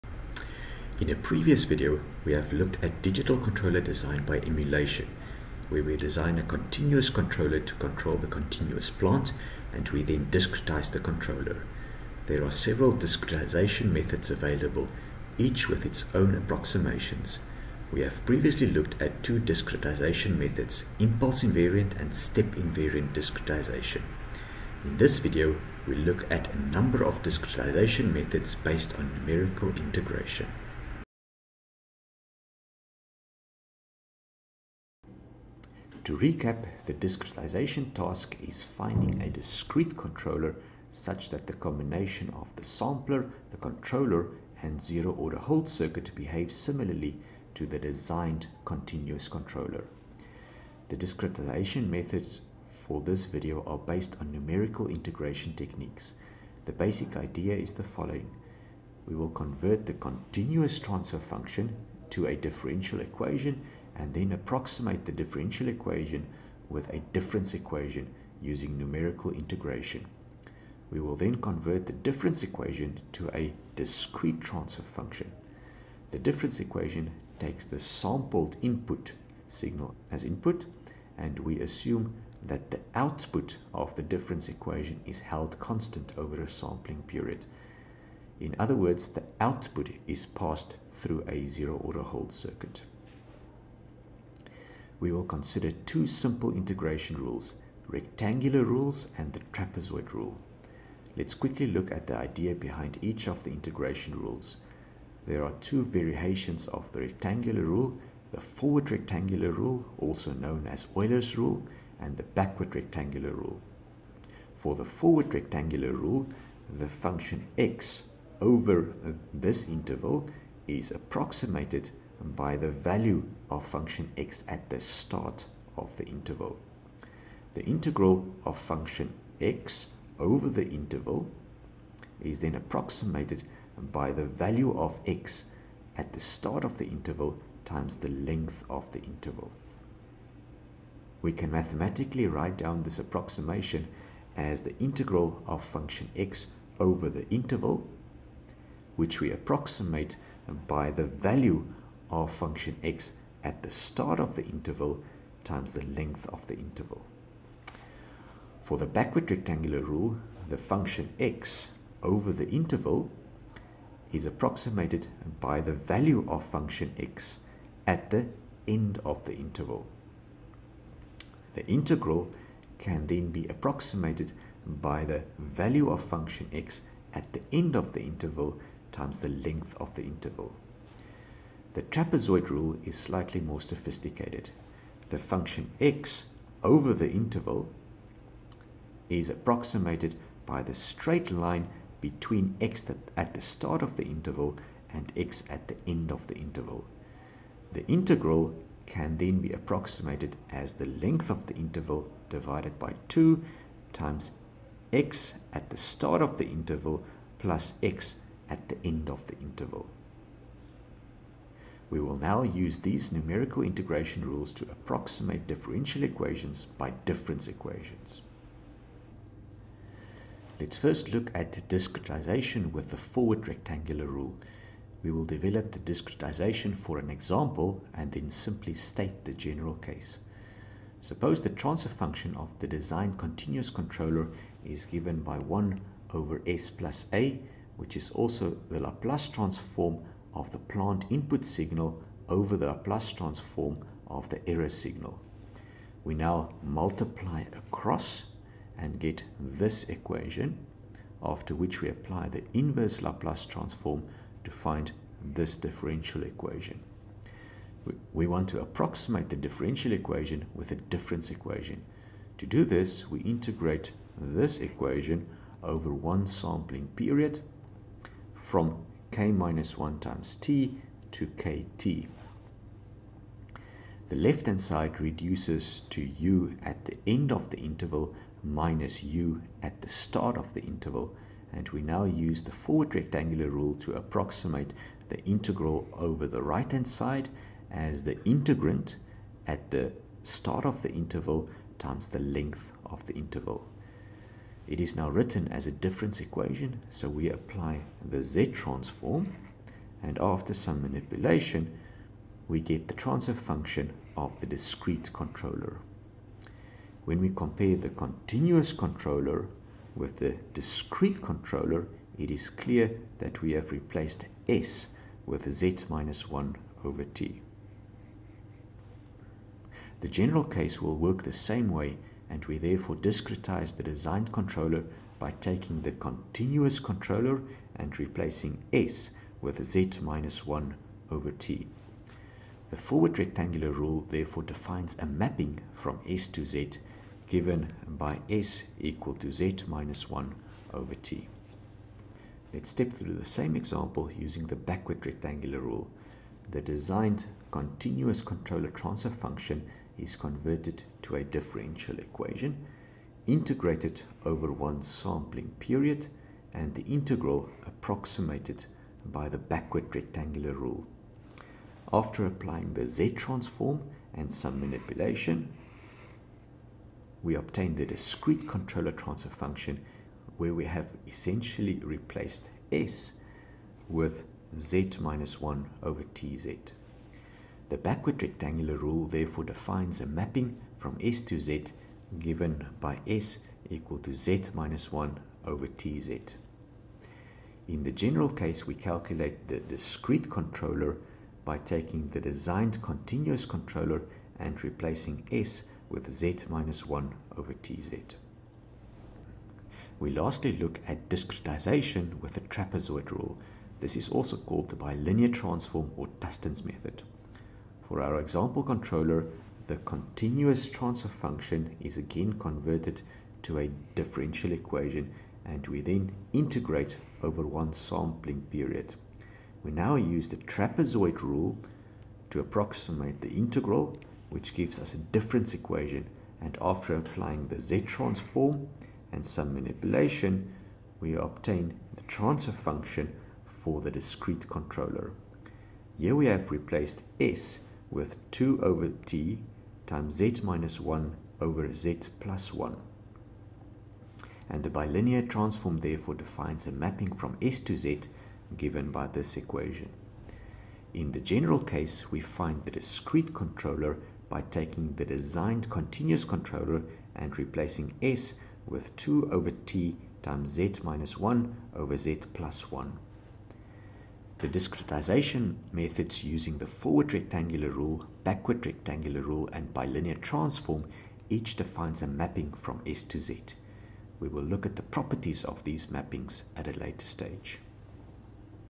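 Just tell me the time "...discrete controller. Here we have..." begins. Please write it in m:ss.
7:13.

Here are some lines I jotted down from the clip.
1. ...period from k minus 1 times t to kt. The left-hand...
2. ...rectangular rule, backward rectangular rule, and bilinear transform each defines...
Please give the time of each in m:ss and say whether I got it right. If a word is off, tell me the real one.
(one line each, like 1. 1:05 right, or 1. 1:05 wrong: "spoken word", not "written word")
1. 4:26 right
2. 7:47 right.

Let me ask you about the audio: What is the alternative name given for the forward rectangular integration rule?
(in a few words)
Euler's rule.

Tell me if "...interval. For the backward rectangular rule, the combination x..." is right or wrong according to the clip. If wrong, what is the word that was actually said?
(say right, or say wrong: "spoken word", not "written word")
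wrong: "function", not "combination".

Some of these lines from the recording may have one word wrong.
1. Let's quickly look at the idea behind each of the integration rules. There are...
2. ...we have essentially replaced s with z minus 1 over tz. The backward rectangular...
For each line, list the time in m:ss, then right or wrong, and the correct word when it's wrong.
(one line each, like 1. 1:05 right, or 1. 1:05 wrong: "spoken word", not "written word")
1. 1:41 right
2. 6:10 right.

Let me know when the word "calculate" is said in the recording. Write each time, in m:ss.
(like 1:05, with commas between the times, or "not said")
6:28.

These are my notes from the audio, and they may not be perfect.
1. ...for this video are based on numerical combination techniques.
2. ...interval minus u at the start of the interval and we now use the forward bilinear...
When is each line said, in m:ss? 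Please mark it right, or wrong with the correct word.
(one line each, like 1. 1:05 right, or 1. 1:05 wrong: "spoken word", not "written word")
1. 0:52 wrong: "integration", not "combination"
2. 4:37 wrong: "rectangular", not "bilinear".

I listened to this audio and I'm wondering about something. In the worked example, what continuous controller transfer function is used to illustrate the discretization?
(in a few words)
1 over s plus a.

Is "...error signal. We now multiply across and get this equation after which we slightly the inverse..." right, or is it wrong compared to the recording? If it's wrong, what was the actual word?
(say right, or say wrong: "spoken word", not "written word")
wrong: "apply", not "slightly".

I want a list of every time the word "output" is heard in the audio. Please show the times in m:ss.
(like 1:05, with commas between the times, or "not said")
1:22, 1:29.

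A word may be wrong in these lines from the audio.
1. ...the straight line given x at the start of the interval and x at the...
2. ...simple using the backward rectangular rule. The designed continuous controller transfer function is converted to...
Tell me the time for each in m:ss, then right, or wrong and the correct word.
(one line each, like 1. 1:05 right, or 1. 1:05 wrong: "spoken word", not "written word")
1. 3:10 wrong: "between", not "given"
2. 5:43 wrong: "example", not "simple".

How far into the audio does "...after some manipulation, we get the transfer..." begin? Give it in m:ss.
5:00.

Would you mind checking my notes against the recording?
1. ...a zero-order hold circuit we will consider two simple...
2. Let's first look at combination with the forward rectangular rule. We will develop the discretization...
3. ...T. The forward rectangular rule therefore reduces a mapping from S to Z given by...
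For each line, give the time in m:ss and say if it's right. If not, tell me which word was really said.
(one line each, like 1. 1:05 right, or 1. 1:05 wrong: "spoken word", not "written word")
1. 1:31 right
2. 3:40 wrong: "discretization", not "combination"
3. 5:31 wrong: "defines", not "reduces".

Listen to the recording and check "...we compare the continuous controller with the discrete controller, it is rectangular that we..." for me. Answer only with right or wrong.
wrong.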